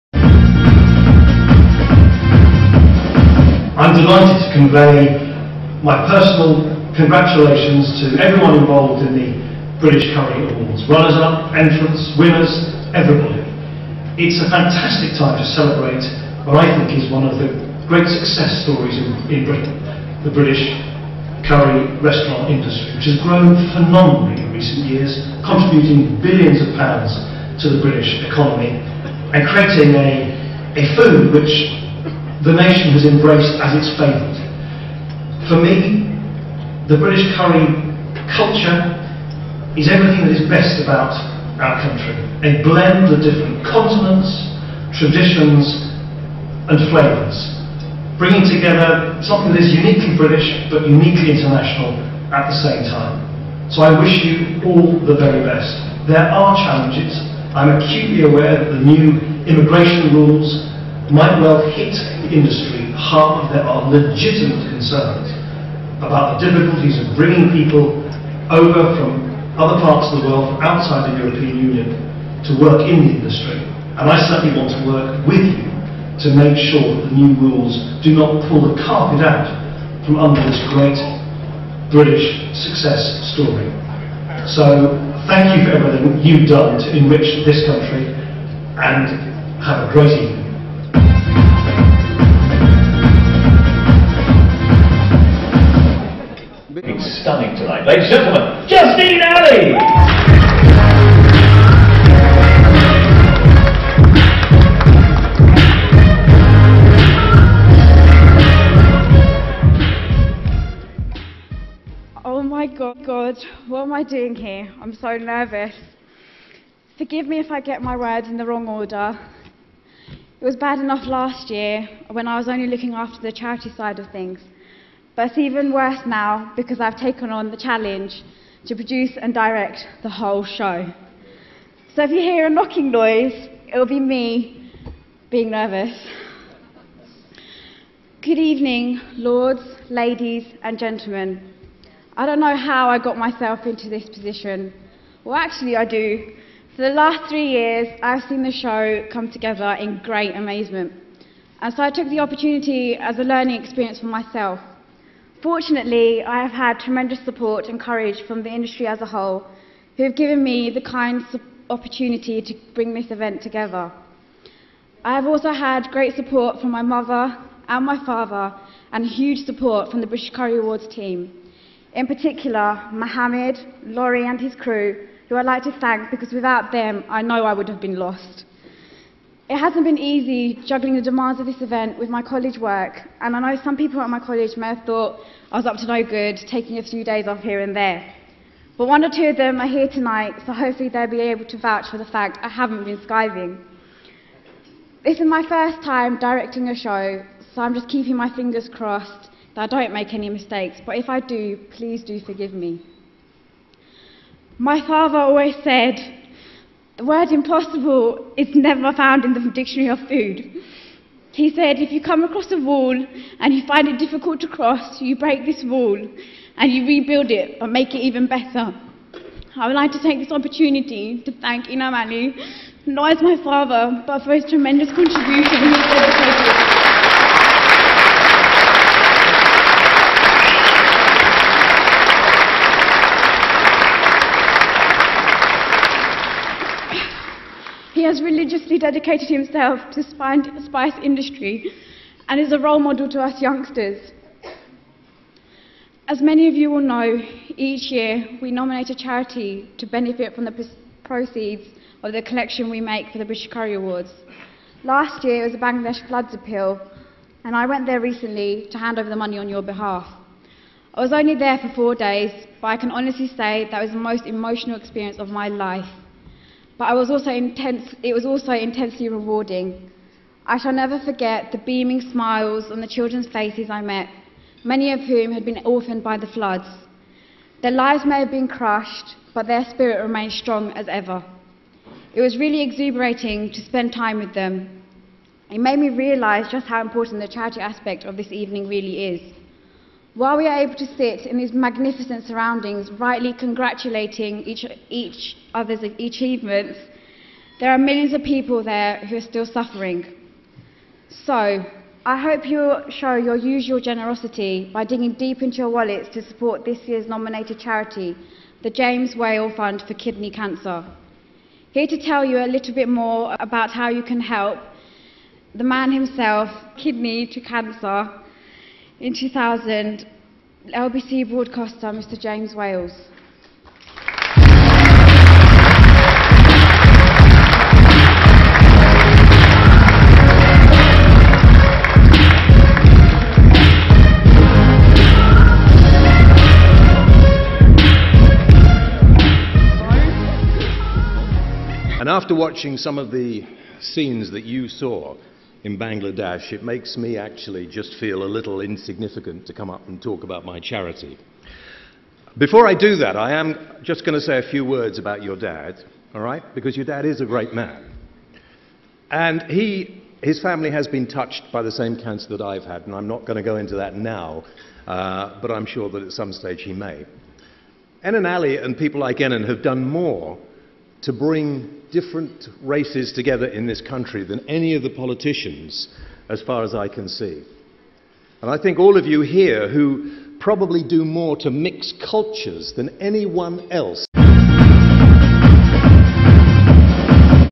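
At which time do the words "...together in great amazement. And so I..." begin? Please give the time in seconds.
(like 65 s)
149 s.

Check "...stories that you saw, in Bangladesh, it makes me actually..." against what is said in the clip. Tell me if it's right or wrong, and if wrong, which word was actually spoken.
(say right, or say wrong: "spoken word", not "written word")
wrong: "scenes", not "stories".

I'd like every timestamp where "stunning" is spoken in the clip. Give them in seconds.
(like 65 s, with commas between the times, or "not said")
97 s.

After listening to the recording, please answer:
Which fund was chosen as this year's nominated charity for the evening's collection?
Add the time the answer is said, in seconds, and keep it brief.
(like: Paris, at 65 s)
James Whale Fund for Kidney Cancer, at 308 s.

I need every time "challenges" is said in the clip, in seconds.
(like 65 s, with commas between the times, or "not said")
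56 s, 127 s.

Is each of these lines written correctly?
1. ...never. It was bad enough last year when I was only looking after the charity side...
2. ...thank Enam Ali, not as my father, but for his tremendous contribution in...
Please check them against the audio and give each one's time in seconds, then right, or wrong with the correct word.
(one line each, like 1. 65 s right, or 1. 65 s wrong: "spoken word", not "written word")
1. 118 s wrong: "order", not "never"
2. 221 s right.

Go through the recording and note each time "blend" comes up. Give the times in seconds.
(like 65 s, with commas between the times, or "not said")
42 s.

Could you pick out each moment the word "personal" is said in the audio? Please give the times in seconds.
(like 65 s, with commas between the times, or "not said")
6 s.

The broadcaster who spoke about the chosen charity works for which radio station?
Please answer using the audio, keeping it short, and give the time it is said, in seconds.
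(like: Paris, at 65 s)
LBC, at 320 s.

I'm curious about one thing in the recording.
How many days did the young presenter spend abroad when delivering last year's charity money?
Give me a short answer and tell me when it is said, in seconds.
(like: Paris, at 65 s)
4, at 261 s.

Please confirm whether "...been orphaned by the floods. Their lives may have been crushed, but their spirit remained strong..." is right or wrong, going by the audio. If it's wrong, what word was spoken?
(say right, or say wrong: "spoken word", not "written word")
right.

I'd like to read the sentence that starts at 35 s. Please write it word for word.
For me, the British curry culture is everything that is best about our country.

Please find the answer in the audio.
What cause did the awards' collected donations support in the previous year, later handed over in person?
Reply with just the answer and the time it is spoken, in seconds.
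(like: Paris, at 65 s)
Bangladesh floods appeal, at 255 s.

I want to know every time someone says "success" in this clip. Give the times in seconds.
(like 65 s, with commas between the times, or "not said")
18 s, 82 s.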